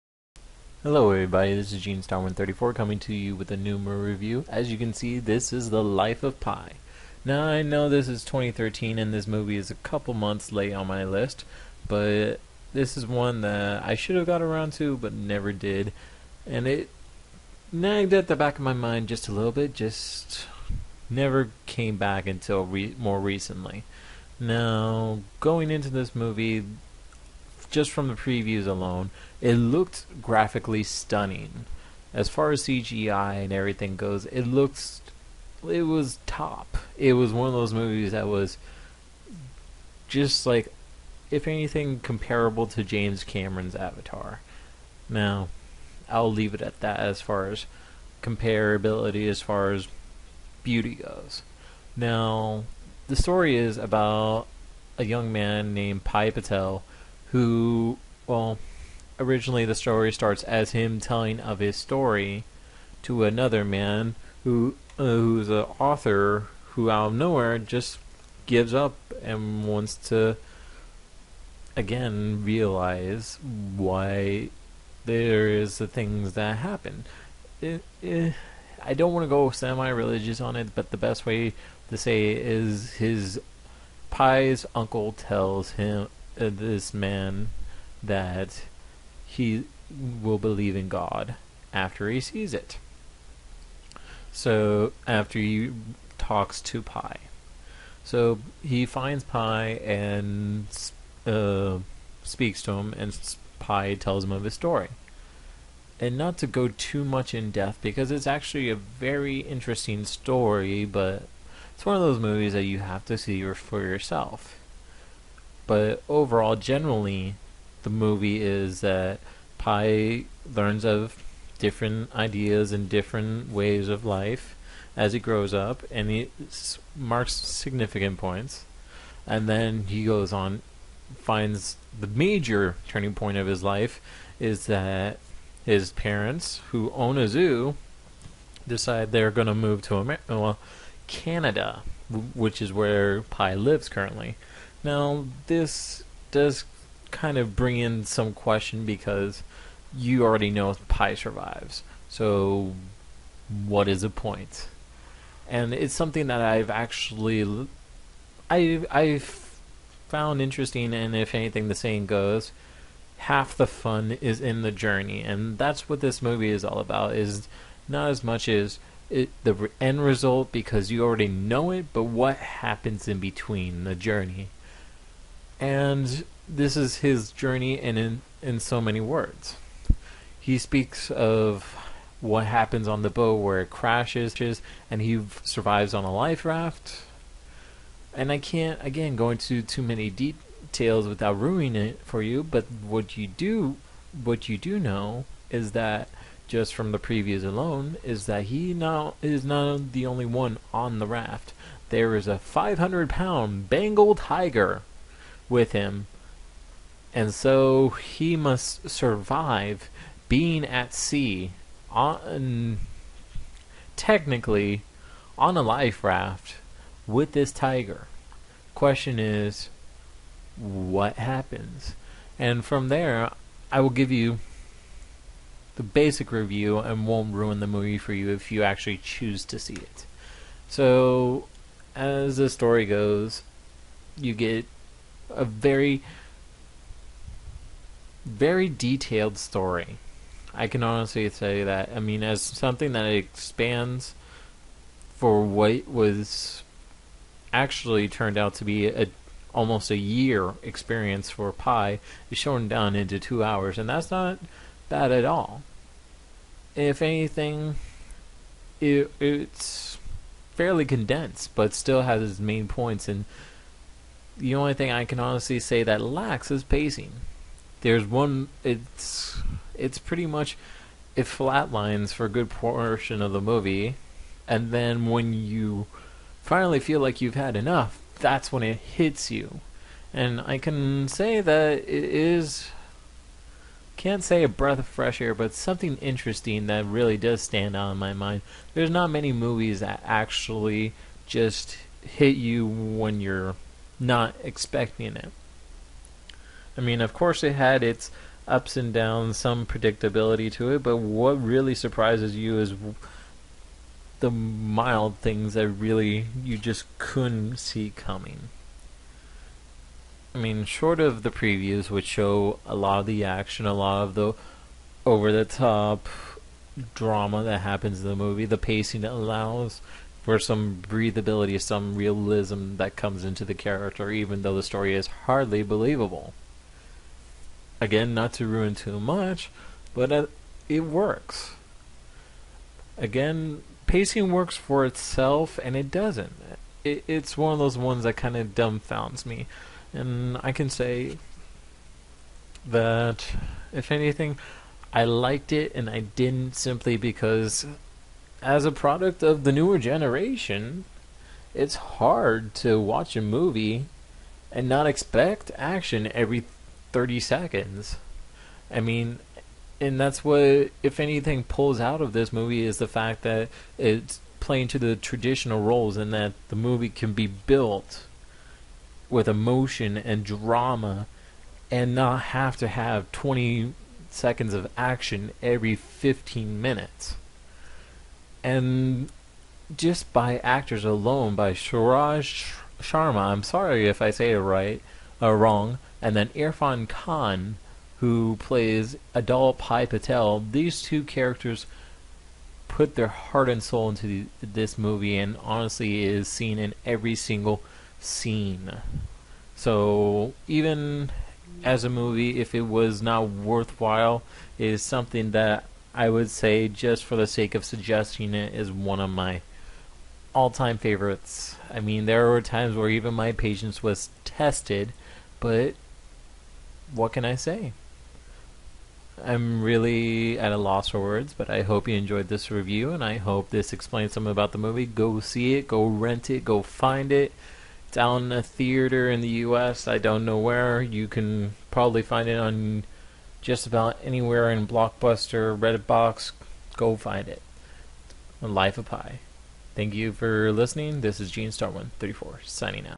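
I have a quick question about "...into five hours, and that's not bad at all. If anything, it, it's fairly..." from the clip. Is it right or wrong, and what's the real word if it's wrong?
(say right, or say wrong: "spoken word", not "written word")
wrong: "two", not "five".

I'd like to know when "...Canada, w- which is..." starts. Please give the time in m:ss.
2:21.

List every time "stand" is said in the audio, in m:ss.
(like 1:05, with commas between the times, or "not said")
4:47.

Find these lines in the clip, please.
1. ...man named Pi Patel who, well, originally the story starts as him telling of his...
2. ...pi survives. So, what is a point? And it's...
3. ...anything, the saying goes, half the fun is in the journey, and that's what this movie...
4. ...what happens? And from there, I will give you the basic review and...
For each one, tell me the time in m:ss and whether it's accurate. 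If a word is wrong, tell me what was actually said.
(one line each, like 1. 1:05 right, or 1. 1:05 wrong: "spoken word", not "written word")
1. 0:55 right
2. 2:30 right
3. 2:41 right
4. 3:40 right.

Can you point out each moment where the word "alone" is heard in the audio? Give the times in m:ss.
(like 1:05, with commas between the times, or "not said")
0:28, 3:17, 6:20.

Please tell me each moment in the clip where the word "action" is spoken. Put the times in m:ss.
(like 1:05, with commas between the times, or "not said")
5:13, 5:55, 6:14.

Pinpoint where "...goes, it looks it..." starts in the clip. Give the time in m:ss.
0:33.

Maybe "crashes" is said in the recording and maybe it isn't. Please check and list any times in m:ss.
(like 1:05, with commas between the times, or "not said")
3:03.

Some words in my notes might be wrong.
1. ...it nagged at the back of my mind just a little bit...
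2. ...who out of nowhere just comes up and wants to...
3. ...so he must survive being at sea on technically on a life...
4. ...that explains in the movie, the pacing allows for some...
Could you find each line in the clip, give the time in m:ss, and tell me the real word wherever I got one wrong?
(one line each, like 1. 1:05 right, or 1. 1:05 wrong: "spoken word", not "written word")
1. 0:16 right
2. 1:06 wrong: "gives", not "comes"
3. 3:27 right
4. 5:17 wrong: "happens", not "explains".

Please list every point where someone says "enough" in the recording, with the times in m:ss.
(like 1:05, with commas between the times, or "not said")
4:37.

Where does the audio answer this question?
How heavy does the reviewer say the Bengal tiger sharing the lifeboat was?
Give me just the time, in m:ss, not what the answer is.
3:22.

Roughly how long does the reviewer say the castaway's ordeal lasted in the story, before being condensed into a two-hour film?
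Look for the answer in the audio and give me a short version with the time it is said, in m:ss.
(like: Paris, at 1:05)
almost a year, at 4:09.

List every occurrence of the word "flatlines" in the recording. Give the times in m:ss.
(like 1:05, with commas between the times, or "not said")
4:31.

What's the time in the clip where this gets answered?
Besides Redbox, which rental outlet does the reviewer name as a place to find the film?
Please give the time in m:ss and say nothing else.
7:14.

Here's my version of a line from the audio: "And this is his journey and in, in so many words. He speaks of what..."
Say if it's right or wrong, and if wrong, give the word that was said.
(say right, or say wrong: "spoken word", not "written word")
right.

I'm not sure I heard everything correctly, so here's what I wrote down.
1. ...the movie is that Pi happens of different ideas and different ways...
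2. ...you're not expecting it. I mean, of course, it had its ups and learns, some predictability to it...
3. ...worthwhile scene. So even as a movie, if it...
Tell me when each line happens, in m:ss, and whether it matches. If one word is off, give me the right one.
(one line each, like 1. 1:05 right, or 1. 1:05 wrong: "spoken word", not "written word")
1. 1:57 wrong: "learns", not "happens"
2. 4:53 wrong: "downs", not "learns"
3. 6:37 wrong: "single", not "worthwhile".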